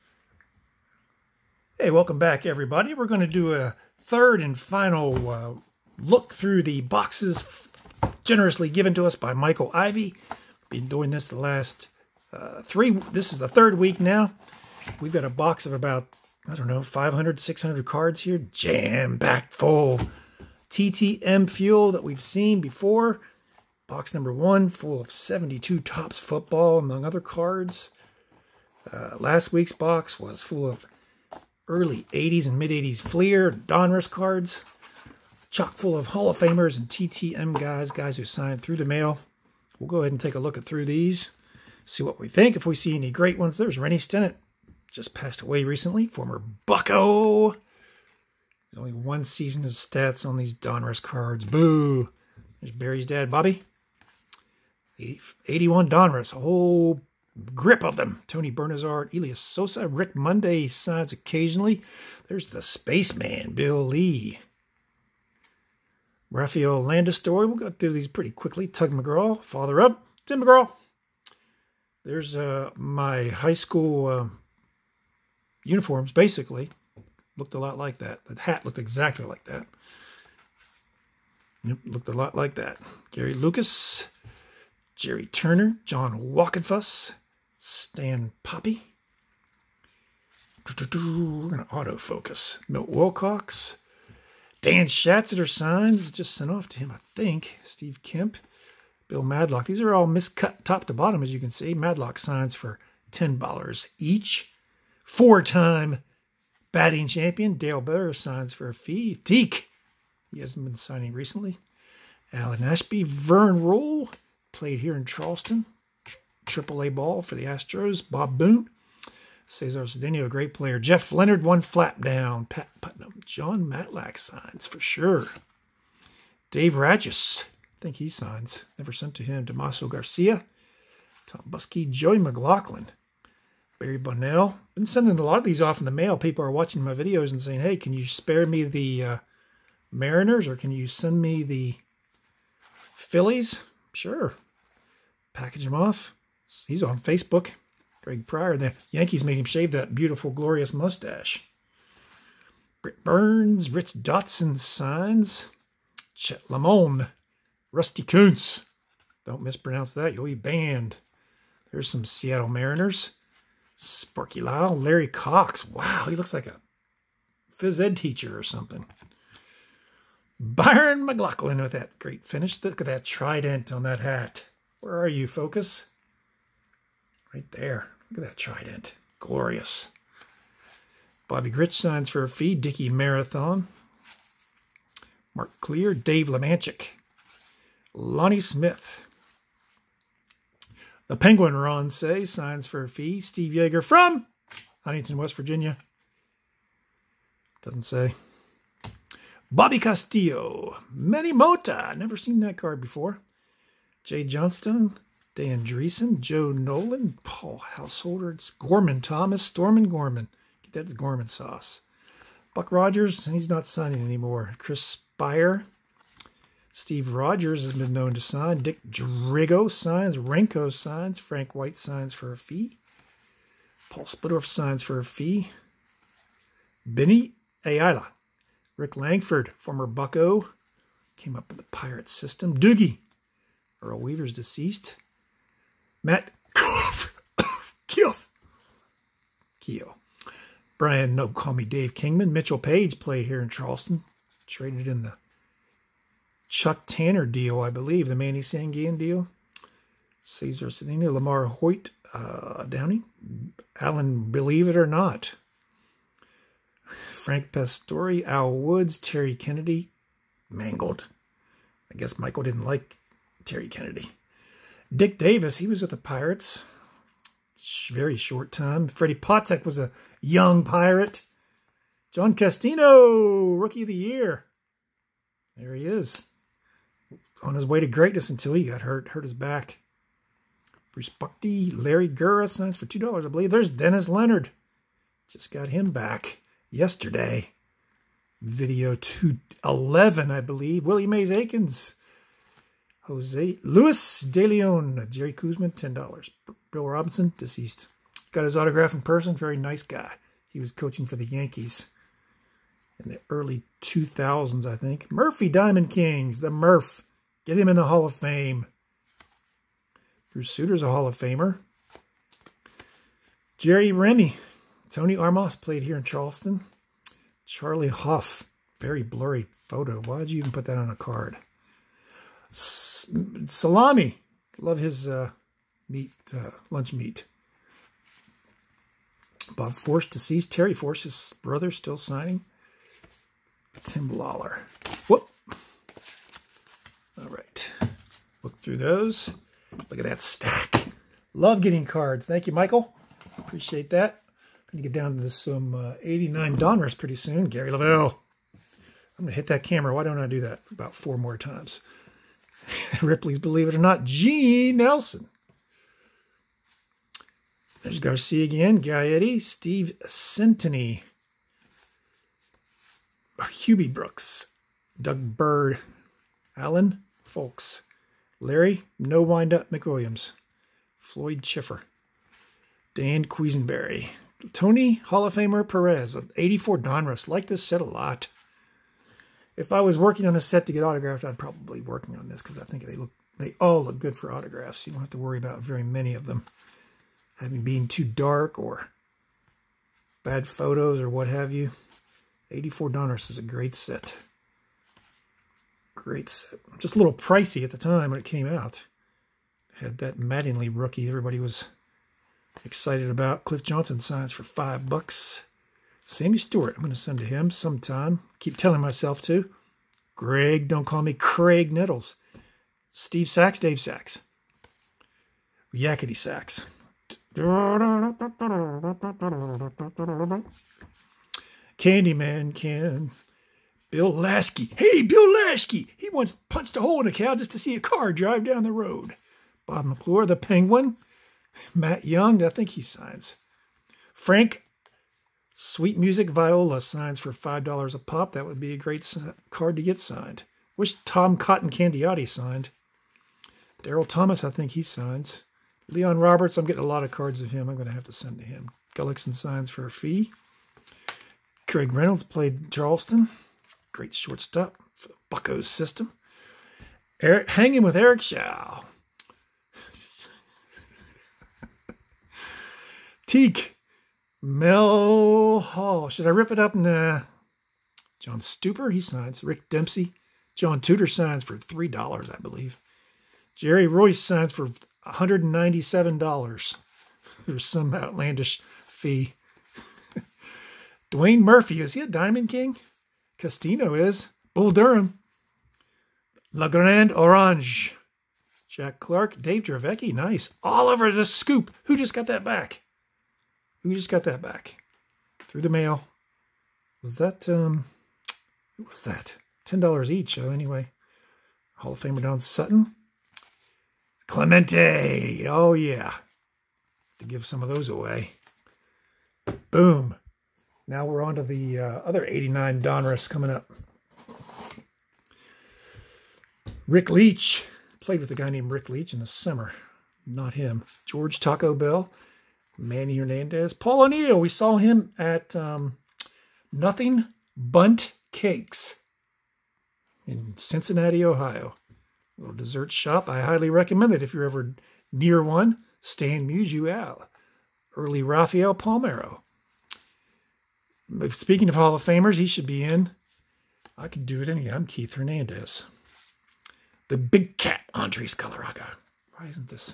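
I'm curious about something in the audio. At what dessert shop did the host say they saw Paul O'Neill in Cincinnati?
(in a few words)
Nothing Bundt Cakes.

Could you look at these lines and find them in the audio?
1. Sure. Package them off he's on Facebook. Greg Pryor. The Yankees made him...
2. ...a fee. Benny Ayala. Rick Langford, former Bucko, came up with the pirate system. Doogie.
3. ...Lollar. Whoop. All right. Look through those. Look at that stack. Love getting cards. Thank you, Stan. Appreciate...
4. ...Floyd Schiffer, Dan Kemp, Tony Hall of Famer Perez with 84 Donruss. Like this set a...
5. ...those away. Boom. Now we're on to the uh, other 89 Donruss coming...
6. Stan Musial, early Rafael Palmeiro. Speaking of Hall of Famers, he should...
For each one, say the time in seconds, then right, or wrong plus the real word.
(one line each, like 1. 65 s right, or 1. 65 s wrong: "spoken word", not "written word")
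1. 143 s right
2. 224 s right
3. 334 s wrong: "Michael", not "Stan"
4. 370 s wrong: "Quisenberry", not "Kemp"
5. 507 s right
6. 536 s right.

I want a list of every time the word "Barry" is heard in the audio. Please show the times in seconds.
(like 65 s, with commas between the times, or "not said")
52 s, 133 s.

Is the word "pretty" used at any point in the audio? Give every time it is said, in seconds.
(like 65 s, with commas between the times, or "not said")
68 s, 346 s.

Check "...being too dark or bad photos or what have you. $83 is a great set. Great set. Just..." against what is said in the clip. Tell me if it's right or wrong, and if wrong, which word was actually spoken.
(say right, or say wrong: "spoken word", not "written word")
wrong: "84", not "83".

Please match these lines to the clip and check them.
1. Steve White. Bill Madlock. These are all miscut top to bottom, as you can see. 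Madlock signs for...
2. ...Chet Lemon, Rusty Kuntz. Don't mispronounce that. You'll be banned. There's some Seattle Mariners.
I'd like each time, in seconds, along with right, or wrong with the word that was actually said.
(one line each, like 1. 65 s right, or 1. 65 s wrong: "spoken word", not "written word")
1. 97 s wrong: "Kemp", not "White"
2. 156 s right.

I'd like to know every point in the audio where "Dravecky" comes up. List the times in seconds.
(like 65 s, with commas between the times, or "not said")
489 s.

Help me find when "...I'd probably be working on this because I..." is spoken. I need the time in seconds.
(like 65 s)
381 s.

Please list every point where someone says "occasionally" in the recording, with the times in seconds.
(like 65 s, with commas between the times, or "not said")
61 s.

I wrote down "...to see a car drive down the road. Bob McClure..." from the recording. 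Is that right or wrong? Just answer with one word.
right.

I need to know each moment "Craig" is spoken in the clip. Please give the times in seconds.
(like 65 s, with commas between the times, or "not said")
411 s, 451 s.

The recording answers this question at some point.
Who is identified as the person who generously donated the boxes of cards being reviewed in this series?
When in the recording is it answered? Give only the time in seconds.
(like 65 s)
9 s.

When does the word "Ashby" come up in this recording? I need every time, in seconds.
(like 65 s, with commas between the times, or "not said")
112 s.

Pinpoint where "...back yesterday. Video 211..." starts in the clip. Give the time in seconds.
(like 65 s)
285 s.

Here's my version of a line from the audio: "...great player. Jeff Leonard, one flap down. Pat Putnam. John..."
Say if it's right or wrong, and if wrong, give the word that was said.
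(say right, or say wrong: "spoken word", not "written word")
right.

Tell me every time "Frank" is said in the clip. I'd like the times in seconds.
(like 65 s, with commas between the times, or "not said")
221 s, 257 s, 434 s.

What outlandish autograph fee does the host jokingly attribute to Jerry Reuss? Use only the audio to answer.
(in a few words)
$197.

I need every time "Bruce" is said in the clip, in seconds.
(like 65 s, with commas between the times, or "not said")
280 s, 310 s.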